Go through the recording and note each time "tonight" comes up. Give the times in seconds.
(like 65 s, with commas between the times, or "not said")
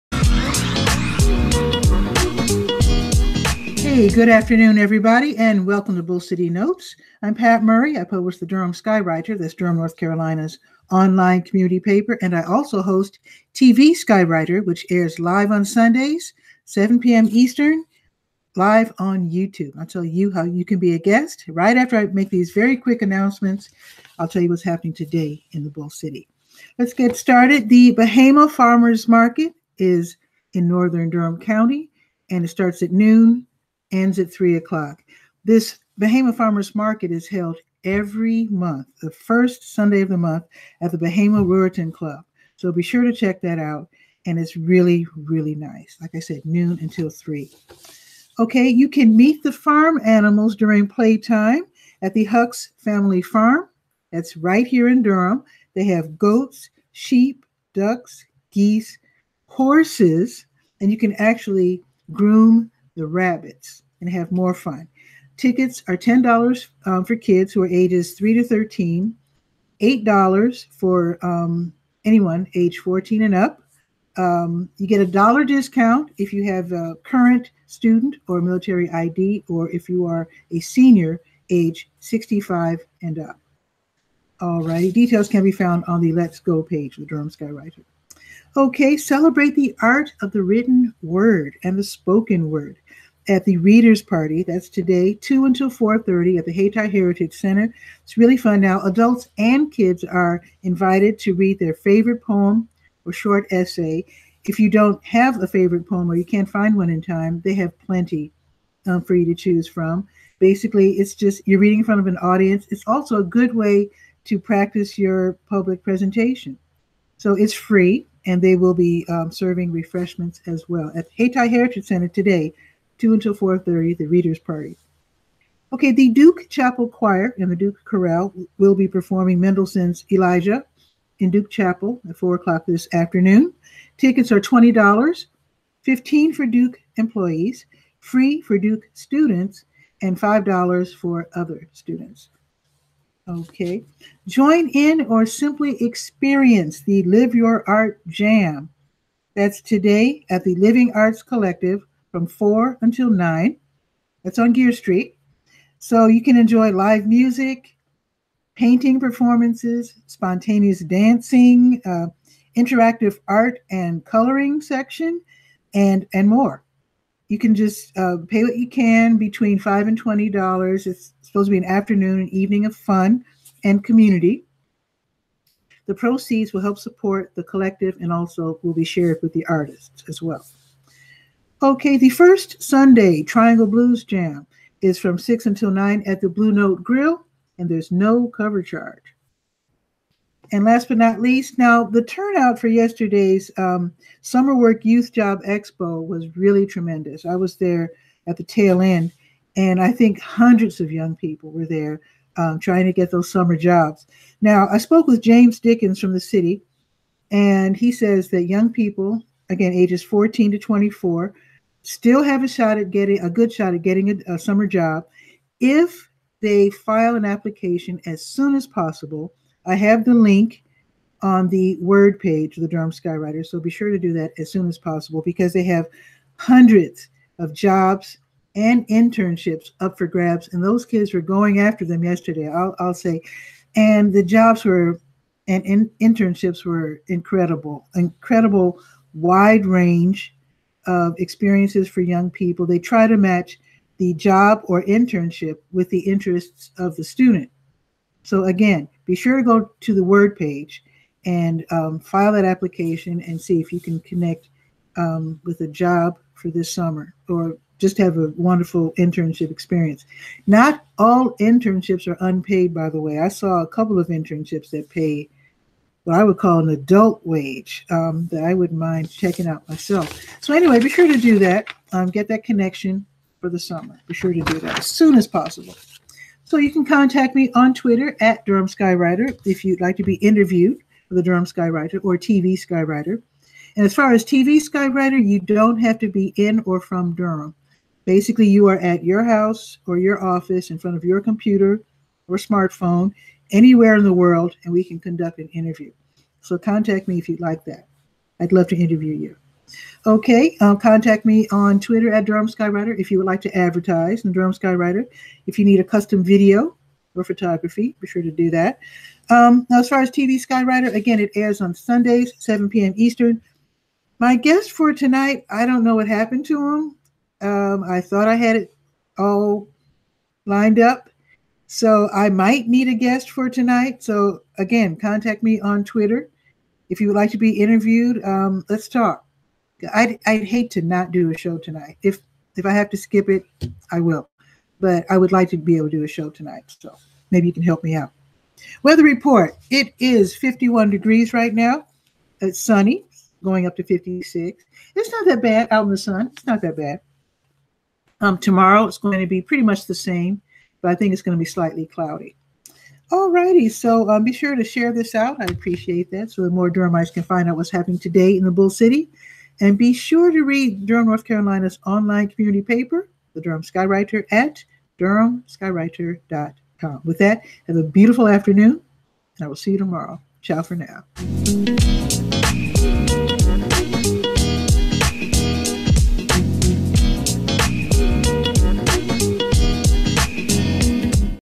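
314 s, 323 s, 331 s, 336 s.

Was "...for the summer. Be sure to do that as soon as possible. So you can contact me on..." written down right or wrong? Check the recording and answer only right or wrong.
right.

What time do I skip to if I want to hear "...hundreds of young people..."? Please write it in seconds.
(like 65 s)
200 s.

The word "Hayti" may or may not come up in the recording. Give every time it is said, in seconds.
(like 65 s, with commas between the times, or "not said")
96 s, 121 s.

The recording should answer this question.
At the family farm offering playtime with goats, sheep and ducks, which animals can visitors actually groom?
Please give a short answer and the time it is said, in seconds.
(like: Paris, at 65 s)
Rabbits, at 63 s.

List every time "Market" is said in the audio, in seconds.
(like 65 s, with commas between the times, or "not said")
29 s, 36 s.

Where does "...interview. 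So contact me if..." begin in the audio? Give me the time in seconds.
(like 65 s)
295 s.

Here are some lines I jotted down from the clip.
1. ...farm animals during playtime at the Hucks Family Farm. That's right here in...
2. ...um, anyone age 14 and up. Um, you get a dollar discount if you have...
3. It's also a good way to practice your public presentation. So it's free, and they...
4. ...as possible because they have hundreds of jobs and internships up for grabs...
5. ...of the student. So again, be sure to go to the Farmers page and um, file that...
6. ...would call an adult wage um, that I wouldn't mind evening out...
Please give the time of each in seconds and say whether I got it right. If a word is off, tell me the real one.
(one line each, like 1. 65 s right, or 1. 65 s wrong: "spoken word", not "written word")
1. 49 s right
2. 71 s right
3. 112 s right
4. 224 s right
5. 246 s wrong: "Word", not "Farmers"
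6. 266 s wrong: "checking", not "evening".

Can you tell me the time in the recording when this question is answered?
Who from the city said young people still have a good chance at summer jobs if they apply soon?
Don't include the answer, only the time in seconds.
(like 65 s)
205 s.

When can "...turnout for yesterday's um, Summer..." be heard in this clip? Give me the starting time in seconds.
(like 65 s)
192 s.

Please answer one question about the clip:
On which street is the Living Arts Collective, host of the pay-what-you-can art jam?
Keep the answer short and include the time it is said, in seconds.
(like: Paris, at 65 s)
Geer Street, at 154 s.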